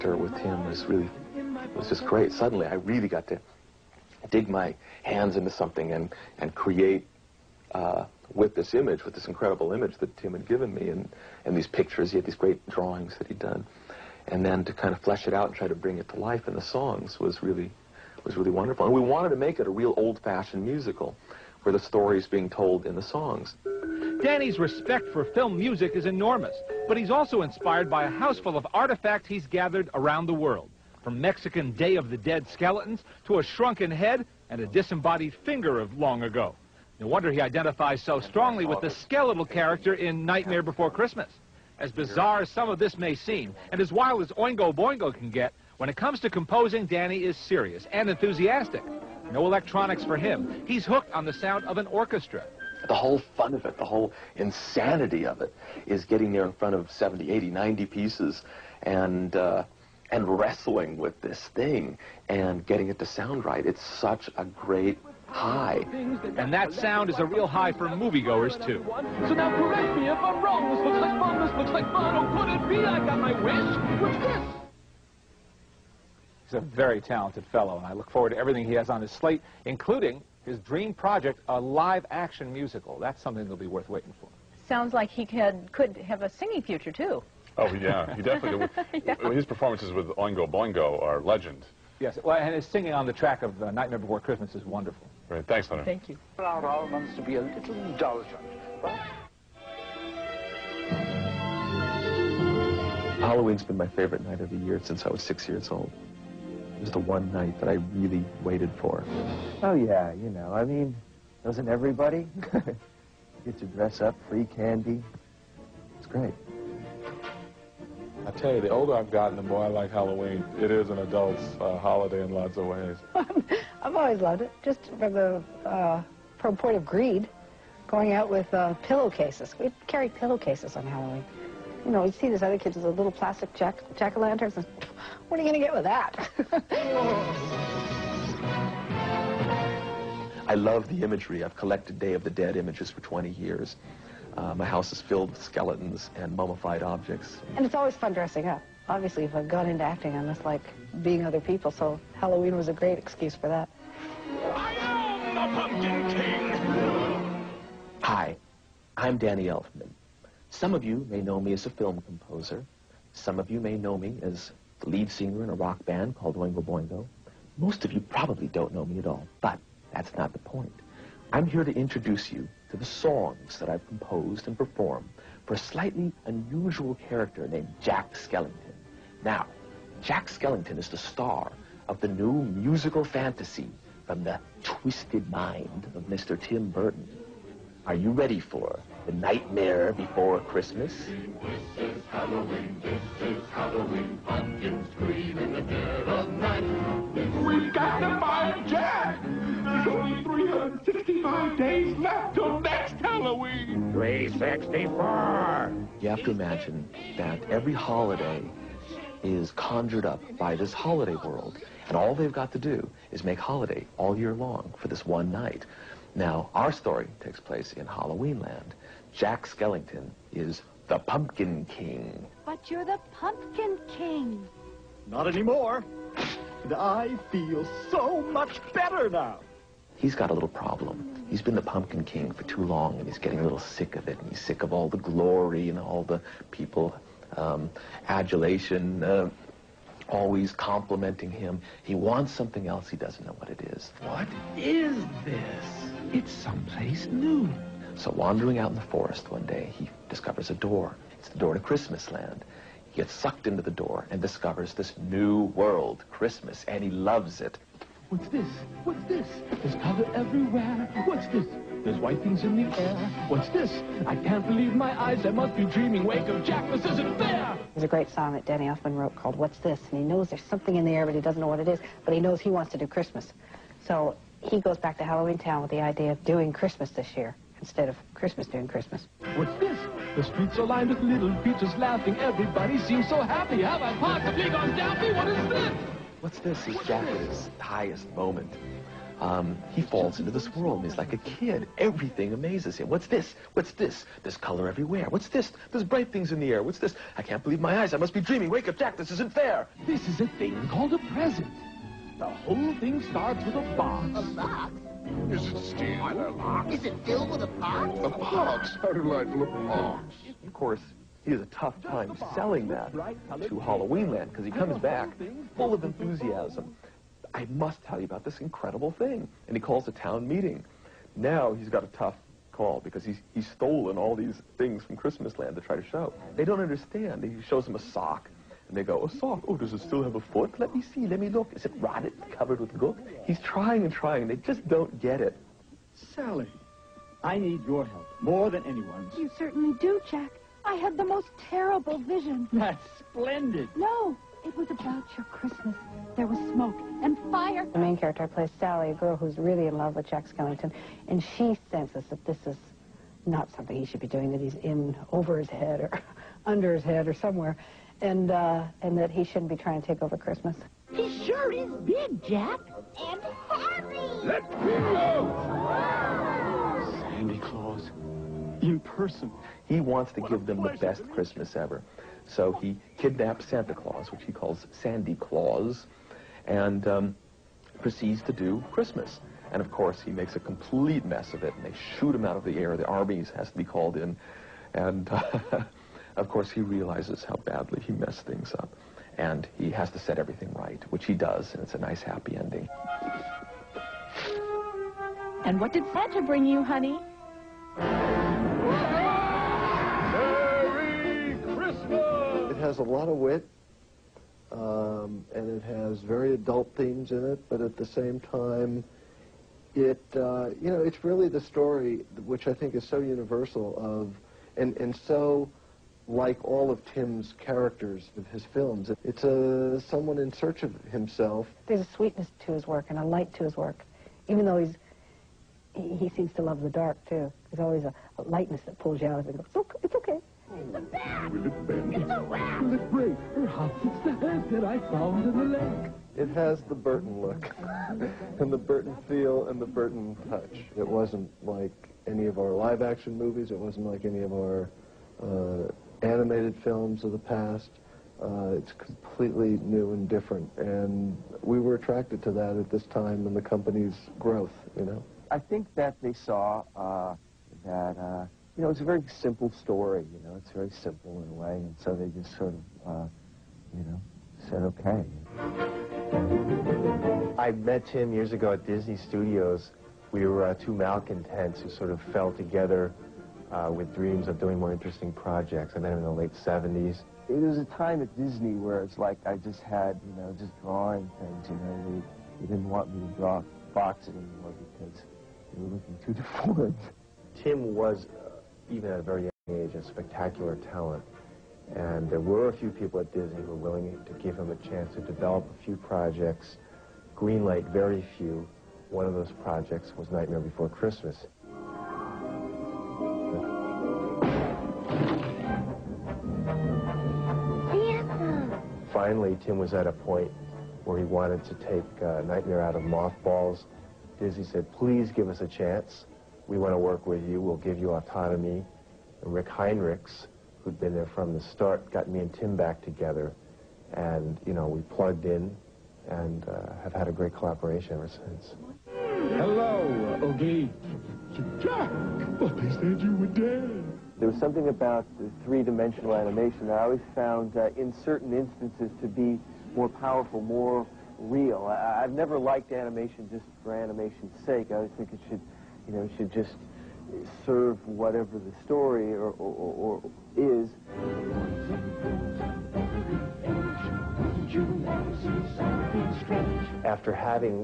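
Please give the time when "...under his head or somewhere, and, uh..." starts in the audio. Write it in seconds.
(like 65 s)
356 s.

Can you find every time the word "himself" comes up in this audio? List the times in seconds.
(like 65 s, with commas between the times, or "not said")
420 s.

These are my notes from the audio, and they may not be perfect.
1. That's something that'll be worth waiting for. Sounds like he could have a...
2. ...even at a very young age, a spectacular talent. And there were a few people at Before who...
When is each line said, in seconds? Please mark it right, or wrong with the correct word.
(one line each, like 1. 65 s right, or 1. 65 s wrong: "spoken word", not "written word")
1. 82 s right
2. 488 s wrong: "Disney", not "Before".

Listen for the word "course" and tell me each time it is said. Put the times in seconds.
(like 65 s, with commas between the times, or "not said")
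310 s, 379 s, 386 s.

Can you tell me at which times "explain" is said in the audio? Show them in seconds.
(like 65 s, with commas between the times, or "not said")
not said.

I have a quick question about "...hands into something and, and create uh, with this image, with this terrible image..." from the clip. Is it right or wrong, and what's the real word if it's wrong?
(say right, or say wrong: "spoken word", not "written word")
wrong: "incredible", not "terrible".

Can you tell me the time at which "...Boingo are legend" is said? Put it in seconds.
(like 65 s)
90 s.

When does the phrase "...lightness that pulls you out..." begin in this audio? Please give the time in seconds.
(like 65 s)
428 s.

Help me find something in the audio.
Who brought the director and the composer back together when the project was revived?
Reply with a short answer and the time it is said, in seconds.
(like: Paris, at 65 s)
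Rick Heinrichs, at 519 s.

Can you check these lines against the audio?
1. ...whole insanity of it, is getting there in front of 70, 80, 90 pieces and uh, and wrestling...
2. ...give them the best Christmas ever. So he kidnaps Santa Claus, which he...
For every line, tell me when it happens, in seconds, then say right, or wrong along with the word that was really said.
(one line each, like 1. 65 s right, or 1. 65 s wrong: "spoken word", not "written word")
1. 53 s right
2. 370 s right.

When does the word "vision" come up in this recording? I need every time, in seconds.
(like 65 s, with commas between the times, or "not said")
341 s.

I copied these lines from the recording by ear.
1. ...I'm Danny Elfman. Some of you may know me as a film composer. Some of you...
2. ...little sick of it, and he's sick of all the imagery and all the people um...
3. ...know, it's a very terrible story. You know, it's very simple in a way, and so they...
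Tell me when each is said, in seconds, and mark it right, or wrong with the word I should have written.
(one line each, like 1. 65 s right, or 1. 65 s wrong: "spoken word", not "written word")
1. 158 s right
2. 233 s wrong: "glory", not "imagery"
3. 458 s wrong: "simple", not "terrible".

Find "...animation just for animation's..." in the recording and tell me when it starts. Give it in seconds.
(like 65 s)
542 s.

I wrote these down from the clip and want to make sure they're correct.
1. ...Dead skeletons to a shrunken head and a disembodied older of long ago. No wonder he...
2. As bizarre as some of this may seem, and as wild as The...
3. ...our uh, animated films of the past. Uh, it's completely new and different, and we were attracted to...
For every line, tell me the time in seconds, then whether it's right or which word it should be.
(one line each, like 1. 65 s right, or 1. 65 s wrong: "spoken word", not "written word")
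1. 32 s wrong: "finger", not "older"
2. 41 s wrong: "Oingo", not "The"
3. 444 s right.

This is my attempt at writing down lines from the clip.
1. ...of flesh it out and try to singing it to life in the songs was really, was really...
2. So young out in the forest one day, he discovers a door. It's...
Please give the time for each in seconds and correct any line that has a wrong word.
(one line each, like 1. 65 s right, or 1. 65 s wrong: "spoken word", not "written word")
1. 14 s wrong: "bring", not "singing"
2. 247 s wrong: "wandering", not "young".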